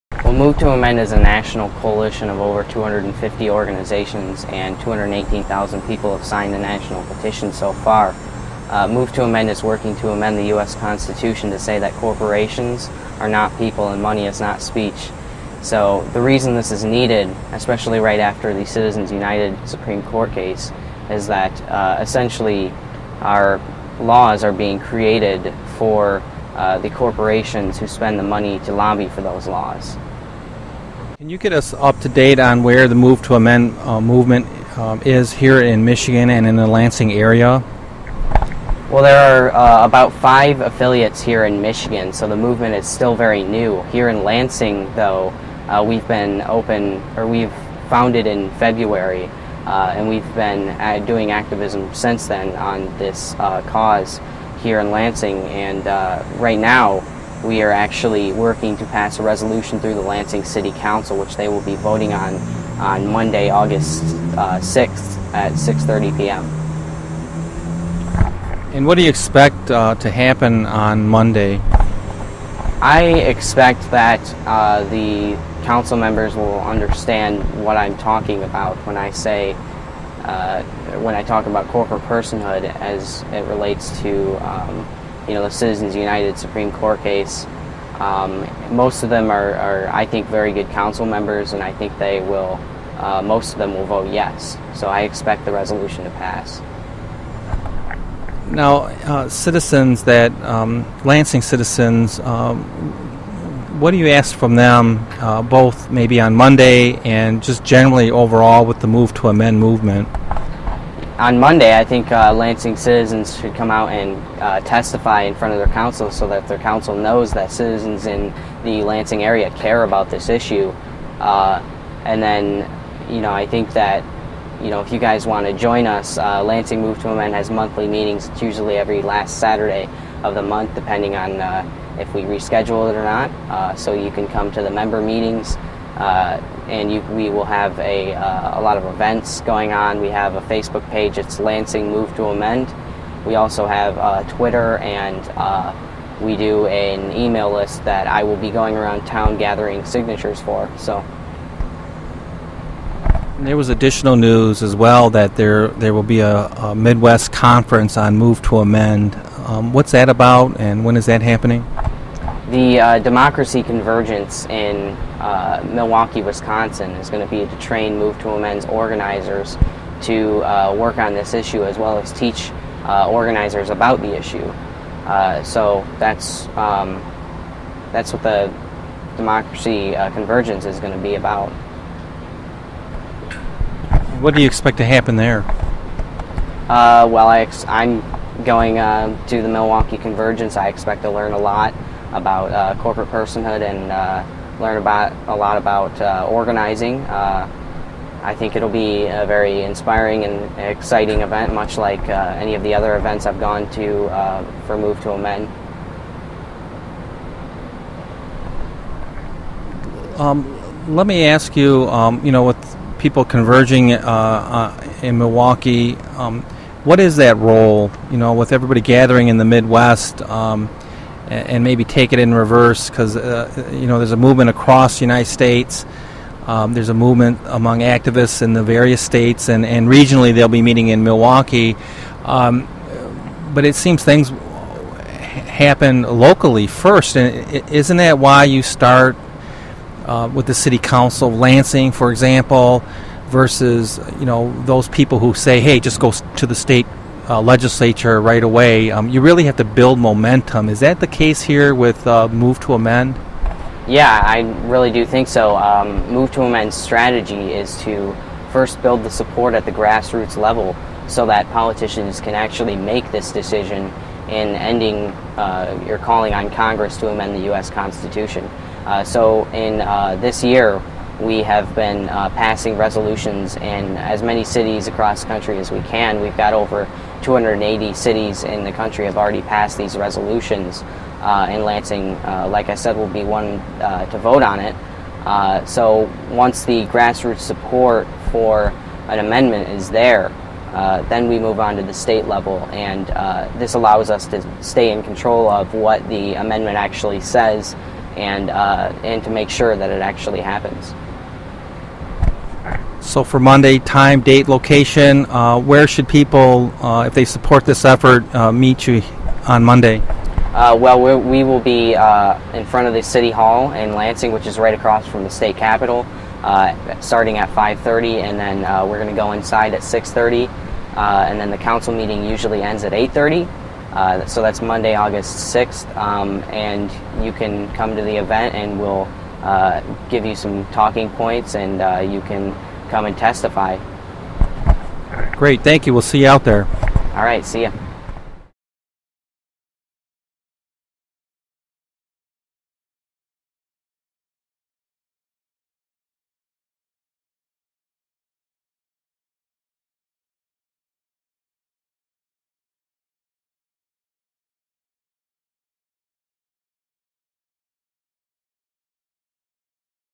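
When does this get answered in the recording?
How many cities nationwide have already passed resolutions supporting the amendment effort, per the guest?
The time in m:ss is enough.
4:36.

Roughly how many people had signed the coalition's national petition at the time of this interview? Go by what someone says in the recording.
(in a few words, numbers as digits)
218,000.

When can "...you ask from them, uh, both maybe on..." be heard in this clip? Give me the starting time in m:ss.
1:43.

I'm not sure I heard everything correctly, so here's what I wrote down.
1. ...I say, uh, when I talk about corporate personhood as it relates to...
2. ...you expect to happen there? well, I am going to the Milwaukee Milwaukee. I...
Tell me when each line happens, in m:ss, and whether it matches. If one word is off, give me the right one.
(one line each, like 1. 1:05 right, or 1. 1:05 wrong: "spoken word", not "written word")
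1. 1:18 right
2. 3:04 wrong: "Convergence", not "Milwaukee".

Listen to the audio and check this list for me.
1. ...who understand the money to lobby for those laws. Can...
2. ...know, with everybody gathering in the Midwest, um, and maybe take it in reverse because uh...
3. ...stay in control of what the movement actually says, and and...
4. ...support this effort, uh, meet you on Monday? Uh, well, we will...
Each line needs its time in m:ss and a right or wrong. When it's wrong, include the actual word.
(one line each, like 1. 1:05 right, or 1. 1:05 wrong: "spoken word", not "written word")
1. 0:27 wrong: "spend", not "understand"
2. 3:38 right
3. 4:54 wrong: "amendment", not "movement"
4. 5:07 right.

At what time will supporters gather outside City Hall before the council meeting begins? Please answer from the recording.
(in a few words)
5:30.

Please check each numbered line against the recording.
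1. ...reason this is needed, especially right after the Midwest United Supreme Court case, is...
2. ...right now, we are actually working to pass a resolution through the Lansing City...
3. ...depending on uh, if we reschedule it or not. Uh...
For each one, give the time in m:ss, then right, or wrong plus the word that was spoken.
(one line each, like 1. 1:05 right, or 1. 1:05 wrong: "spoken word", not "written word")
1. 0:16 wrong: "Citizens", not "Midwest"
2. 0:56 right
3. 2:10 right.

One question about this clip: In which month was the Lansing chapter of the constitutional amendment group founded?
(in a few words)
February.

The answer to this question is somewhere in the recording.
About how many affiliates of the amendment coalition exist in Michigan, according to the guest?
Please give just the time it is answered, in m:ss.
0:40.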